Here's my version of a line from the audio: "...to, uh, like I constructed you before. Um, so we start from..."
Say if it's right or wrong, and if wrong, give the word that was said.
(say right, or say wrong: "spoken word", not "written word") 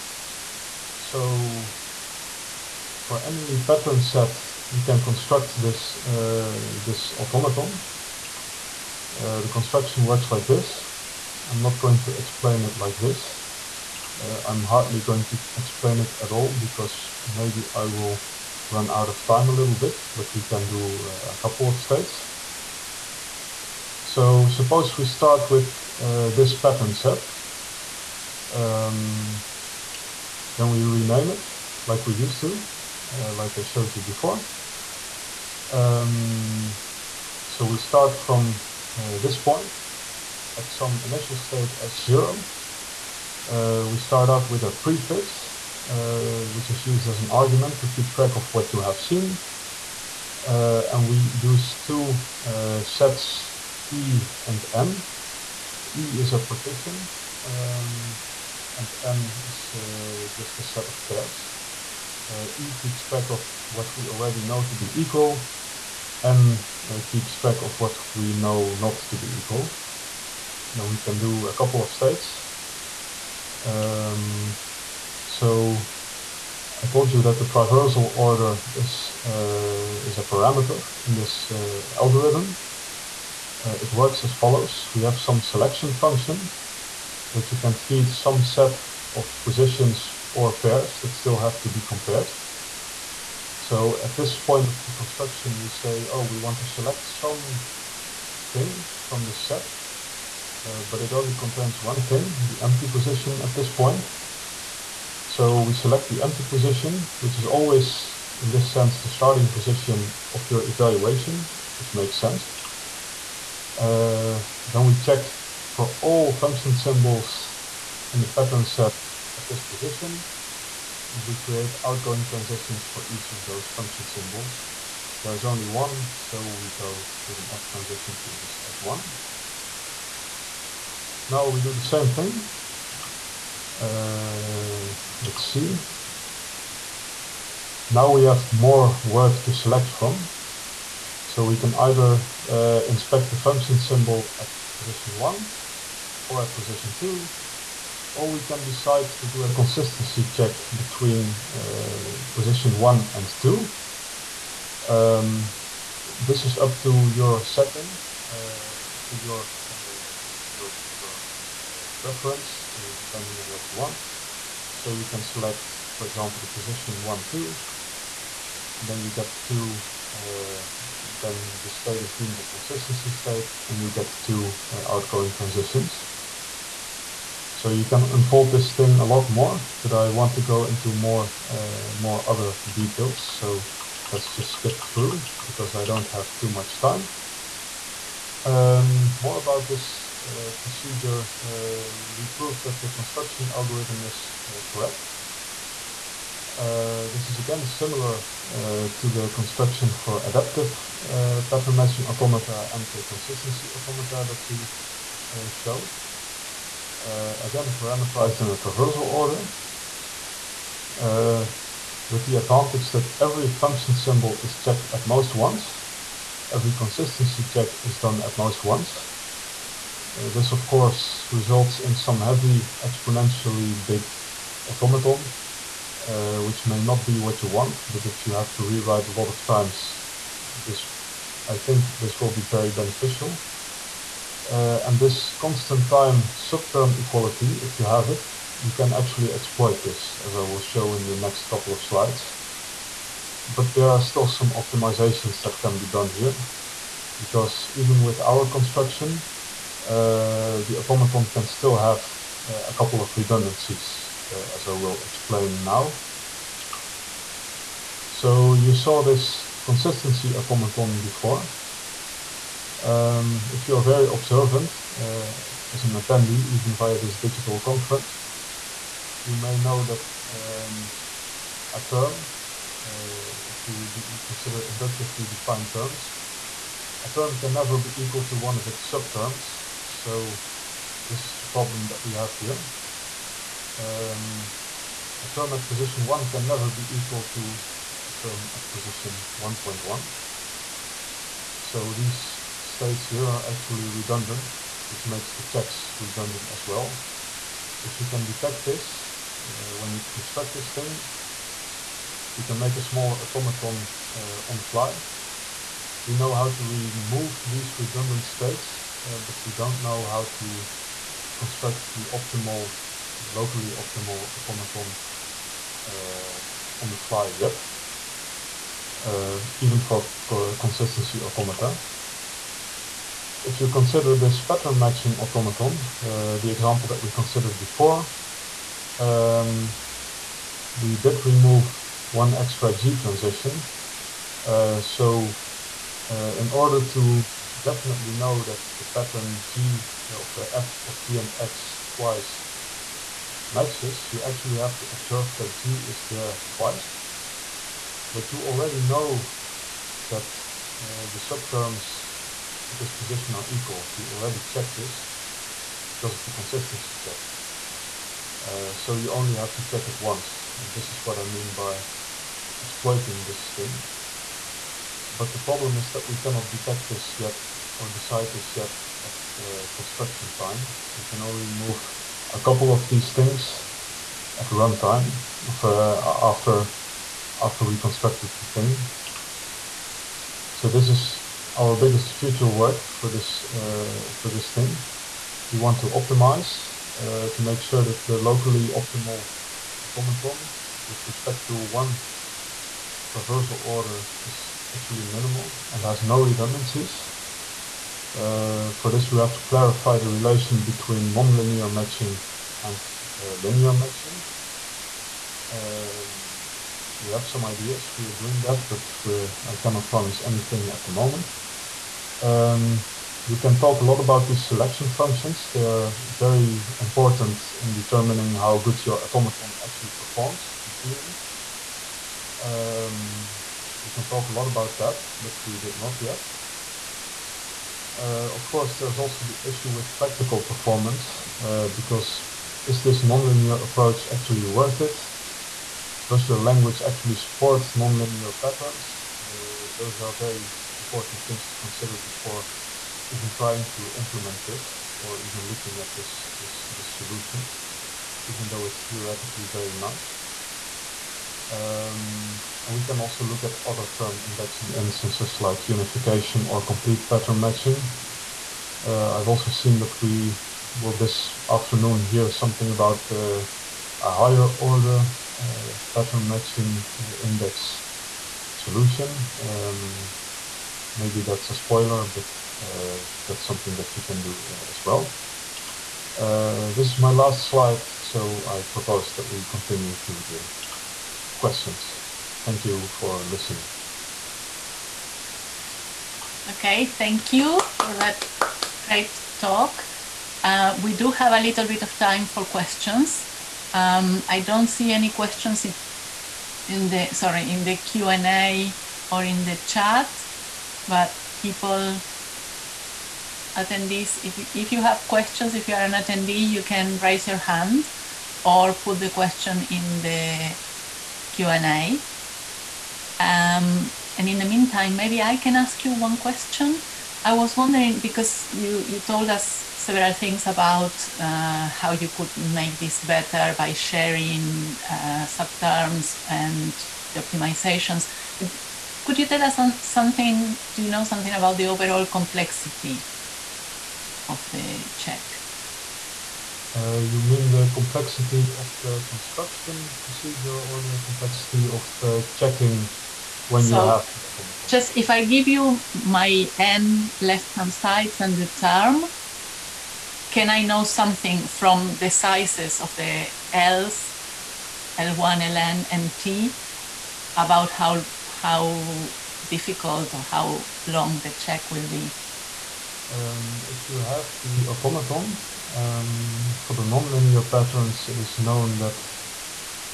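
wrong: "showed", not "constructed".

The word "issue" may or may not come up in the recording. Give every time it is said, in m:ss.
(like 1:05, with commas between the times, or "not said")
7:09.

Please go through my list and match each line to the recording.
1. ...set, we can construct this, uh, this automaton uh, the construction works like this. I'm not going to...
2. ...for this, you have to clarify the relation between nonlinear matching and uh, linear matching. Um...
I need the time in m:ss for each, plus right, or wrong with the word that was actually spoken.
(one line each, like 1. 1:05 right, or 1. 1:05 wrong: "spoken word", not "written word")
1. 0:03 right
2. 6:38 right.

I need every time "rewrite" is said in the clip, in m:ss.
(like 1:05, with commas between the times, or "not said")
3:48.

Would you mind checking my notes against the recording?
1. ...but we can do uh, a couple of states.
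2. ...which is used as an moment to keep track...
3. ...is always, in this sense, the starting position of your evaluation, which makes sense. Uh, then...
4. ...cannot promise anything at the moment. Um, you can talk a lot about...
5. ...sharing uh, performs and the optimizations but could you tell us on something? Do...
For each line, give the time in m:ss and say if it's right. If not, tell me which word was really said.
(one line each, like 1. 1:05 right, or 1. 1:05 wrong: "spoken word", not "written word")
1. 0:20 right
2. 0:46 wrong: "argument", not "moment"
3. 1:47 right
4. 6:49 right
5. 8:43 wrong: "subterms", not "performs".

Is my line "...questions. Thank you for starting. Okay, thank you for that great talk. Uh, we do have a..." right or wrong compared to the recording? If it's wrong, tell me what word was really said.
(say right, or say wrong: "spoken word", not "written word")
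wrong: "listening", not "starting".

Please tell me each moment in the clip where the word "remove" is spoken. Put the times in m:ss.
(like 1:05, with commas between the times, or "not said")
5:06, 5:31.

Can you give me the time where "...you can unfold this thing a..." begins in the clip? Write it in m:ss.
2:57.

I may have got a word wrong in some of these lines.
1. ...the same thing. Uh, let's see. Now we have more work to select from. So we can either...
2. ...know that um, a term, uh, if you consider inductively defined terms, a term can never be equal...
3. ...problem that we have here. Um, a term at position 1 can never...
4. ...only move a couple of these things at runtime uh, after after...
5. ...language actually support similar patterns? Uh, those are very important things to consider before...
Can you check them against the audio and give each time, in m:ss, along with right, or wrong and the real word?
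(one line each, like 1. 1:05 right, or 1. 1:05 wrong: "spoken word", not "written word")
1. 2:11 right
2. 4:29 right
3. 4:41 right
4. 6:11 right
5. 7:16 wrong: "nonlinear", not "similar".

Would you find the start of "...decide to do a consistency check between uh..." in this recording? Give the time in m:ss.
2:28.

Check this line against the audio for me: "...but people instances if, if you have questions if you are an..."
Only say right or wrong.
wrong.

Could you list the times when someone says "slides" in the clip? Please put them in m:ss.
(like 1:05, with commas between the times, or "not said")
4:01, 7:57.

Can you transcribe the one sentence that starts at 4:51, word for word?
So these states here are actually redundant, which makes the checks redundant as well.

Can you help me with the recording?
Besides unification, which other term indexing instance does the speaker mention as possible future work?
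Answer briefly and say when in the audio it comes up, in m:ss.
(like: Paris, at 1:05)
Complete pattern matching, at 7:36.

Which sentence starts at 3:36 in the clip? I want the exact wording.
Every consistency check is done at most once.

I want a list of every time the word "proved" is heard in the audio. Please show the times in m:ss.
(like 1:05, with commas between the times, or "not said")
3:12.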